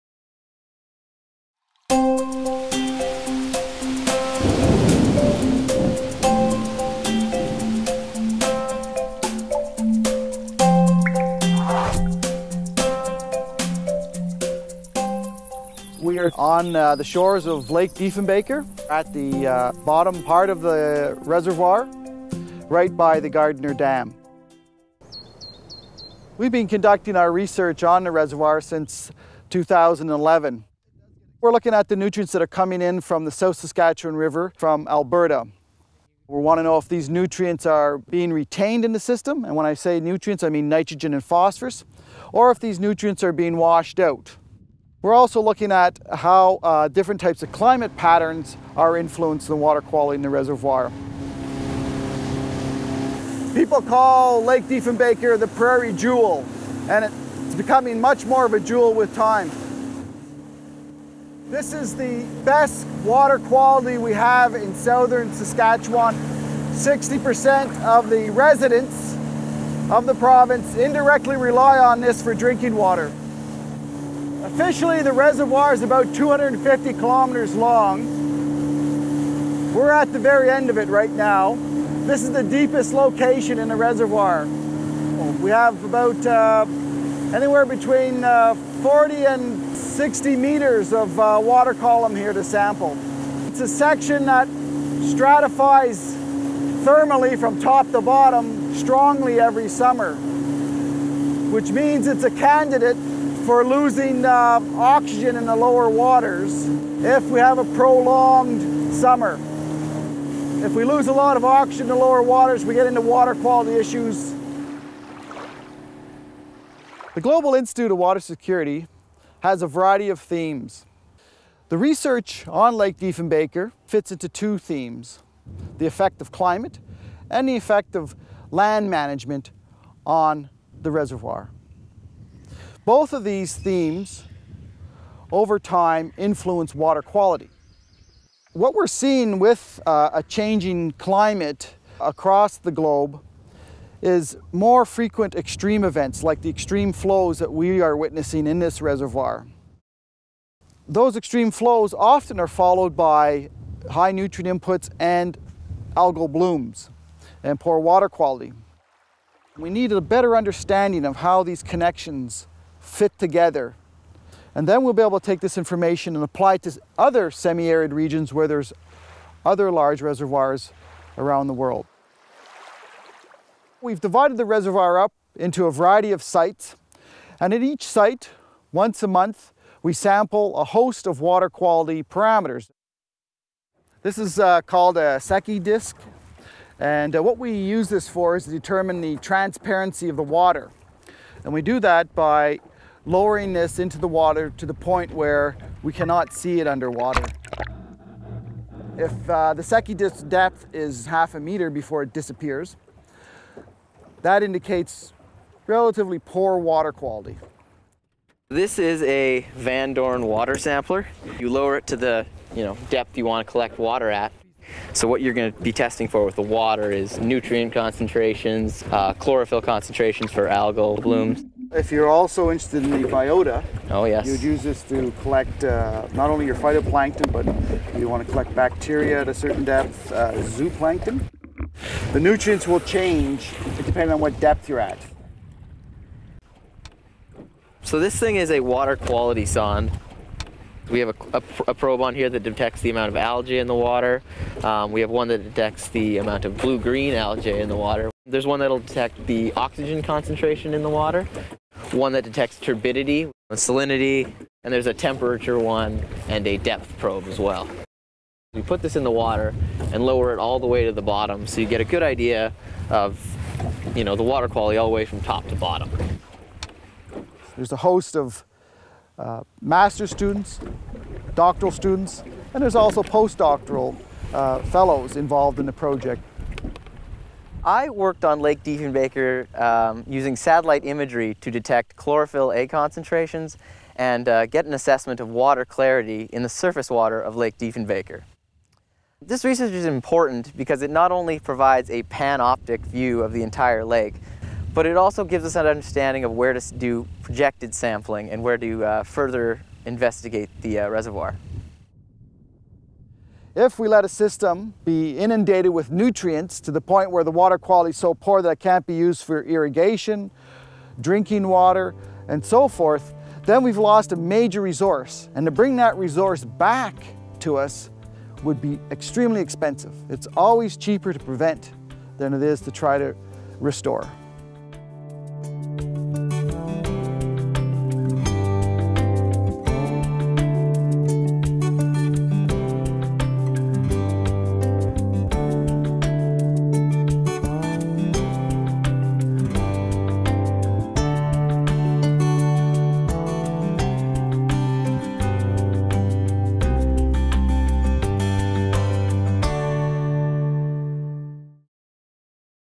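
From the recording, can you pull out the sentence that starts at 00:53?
People call Lake Diefenbaker the prairie jewel, and it's becoming much more of a jewel with time.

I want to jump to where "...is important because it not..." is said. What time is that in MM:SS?
04:49.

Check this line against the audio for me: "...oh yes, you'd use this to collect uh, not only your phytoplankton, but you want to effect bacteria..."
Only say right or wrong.
wrong.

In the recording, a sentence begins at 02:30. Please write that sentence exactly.
Those extreme flows often are followed by high nutrient inputs and algal blooms and poor water quality.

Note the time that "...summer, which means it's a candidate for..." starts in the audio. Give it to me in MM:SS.
01:39.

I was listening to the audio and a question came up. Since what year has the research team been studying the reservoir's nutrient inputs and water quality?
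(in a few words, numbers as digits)
2011.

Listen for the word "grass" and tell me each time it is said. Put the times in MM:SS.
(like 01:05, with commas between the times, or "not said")
not said.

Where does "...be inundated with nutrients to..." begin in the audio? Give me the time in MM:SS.
05:04.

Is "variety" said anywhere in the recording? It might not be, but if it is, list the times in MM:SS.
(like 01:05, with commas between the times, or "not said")
01:59, 02:55.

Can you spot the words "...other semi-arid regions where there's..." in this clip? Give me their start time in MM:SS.
02:46.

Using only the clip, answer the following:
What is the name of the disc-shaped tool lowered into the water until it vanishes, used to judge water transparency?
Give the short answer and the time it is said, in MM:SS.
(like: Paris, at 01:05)
Secchi disc, at 03:05.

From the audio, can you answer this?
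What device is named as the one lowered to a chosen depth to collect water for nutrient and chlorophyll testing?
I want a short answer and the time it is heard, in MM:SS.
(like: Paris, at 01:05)
Van Dorn water sampler, at 03:29.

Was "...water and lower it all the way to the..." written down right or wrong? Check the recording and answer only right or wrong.
right.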